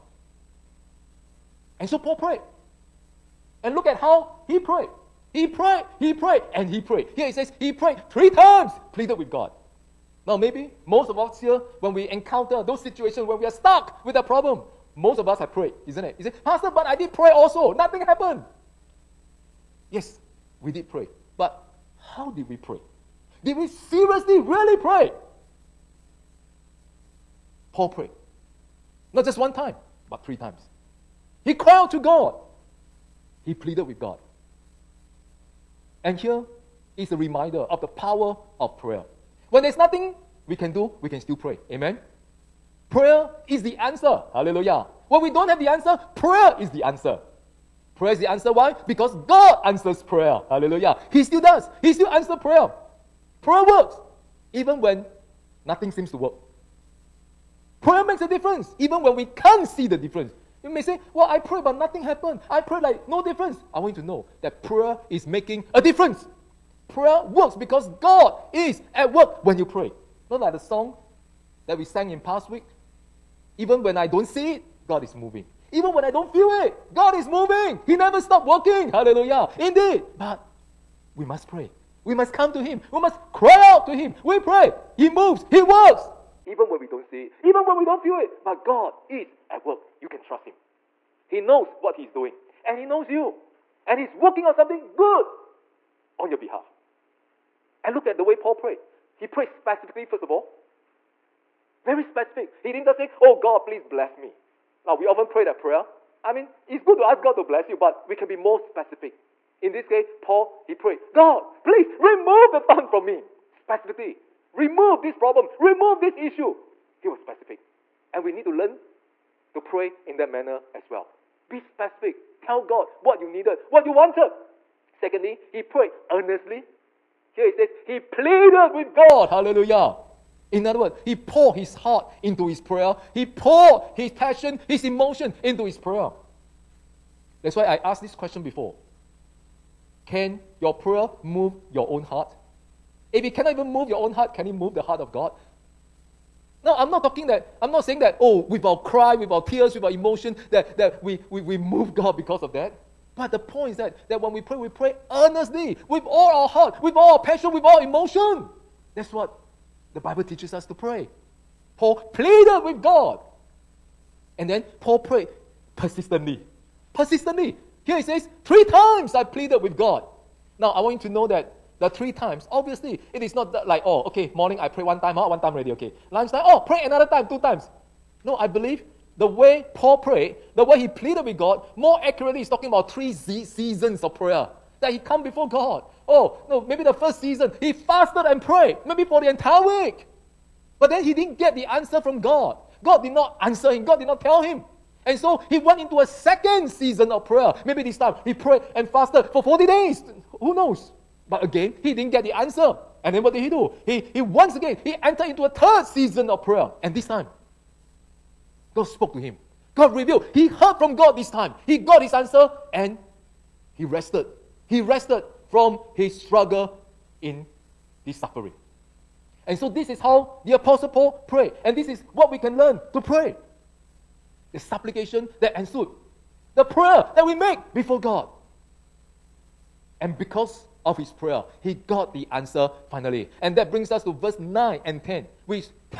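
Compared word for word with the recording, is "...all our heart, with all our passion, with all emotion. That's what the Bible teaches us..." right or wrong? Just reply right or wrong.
right.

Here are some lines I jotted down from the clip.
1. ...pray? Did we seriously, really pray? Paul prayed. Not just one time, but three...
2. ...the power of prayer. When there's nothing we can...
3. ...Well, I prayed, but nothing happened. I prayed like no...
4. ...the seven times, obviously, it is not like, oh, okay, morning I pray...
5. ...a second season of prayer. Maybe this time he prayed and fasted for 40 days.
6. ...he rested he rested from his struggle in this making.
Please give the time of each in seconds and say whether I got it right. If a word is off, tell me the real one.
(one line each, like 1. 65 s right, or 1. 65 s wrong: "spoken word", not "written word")
1. 22 s right
2. 37 s right
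3. 61 s right
4. 171 s wrong: "three", not "seven"
5. 195 s right
6. 213 s wrong: "suffering", not "making".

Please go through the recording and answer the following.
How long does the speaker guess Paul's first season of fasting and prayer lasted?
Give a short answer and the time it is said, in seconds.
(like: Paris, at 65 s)
The entire week, at 189 s.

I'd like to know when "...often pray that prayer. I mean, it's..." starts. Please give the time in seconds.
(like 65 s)
105 s.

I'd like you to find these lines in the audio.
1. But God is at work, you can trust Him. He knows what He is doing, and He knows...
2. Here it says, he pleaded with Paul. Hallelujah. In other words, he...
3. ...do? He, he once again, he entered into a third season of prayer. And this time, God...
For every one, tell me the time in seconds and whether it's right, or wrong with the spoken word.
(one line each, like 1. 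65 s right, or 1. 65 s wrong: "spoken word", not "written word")
1. 88 s right
2. 127 s wrong: "God", not "Paul"
3. 203 s right.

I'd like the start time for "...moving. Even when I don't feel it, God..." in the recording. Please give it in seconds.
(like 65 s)
75 s.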